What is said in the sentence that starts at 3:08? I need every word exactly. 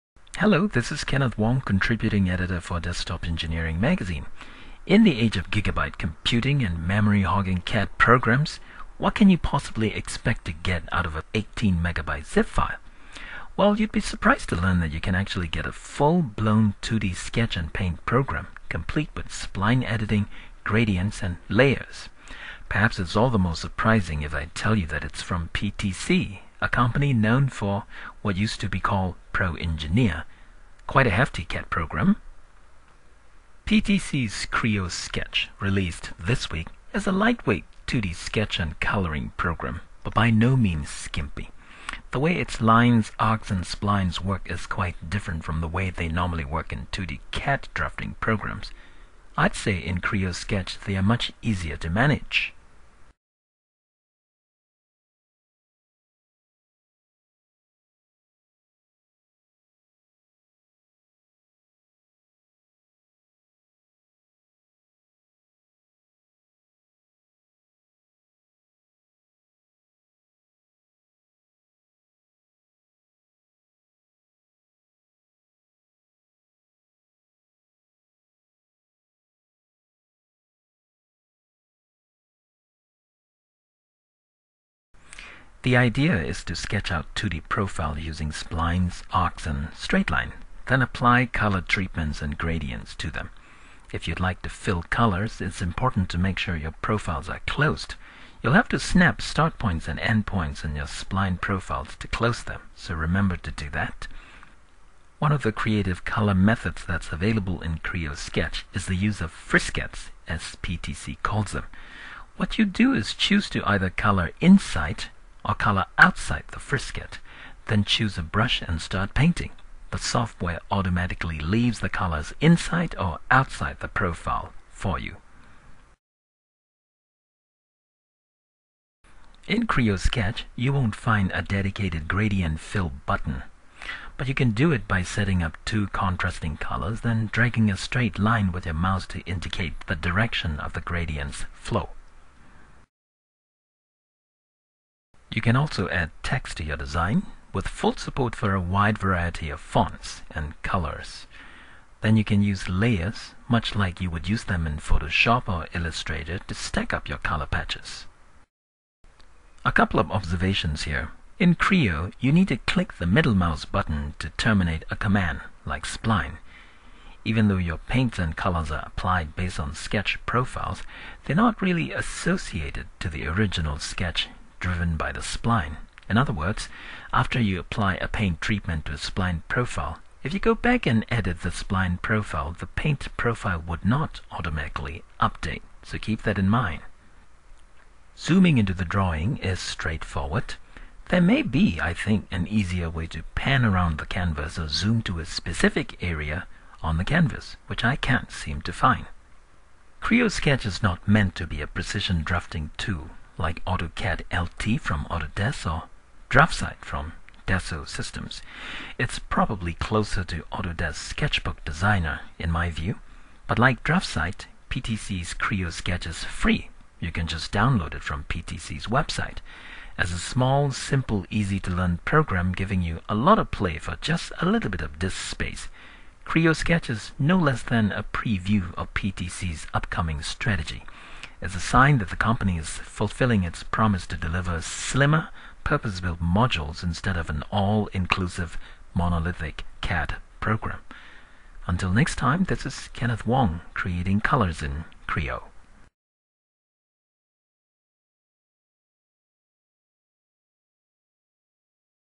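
Zooming into the drawing is straightforward.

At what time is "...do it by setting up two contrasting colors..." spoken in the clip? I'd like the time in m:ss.
2:14.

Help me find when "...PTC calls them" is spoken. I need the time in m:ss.
1:50.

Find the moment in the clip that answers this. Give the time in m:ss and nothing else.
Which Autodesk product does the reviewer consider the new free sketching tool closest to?
3:30.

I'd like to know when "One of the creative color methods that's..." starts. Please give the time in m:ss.
1:45.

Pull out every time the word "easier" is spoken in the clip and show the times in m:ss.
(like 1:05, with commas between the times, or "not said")
0:51, 3:12.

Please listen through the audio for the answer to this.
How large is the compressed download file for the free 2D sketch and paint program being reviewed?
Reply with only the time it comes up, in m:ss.
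0:11.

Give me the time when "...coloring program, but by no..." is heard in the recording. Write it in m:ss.
0:38.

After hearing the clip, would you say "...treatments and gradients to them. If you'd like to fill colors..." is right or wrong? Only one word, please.
right.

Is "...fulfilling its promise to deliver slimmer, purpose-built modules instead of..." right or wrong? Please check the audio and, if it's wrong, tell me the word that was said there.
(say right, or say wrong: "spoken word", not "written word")
right.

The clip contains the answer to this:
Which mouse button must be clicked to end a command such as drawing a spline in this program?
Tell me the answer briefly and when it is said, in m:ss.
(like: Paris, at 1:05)
middle mouse button, at 2:43.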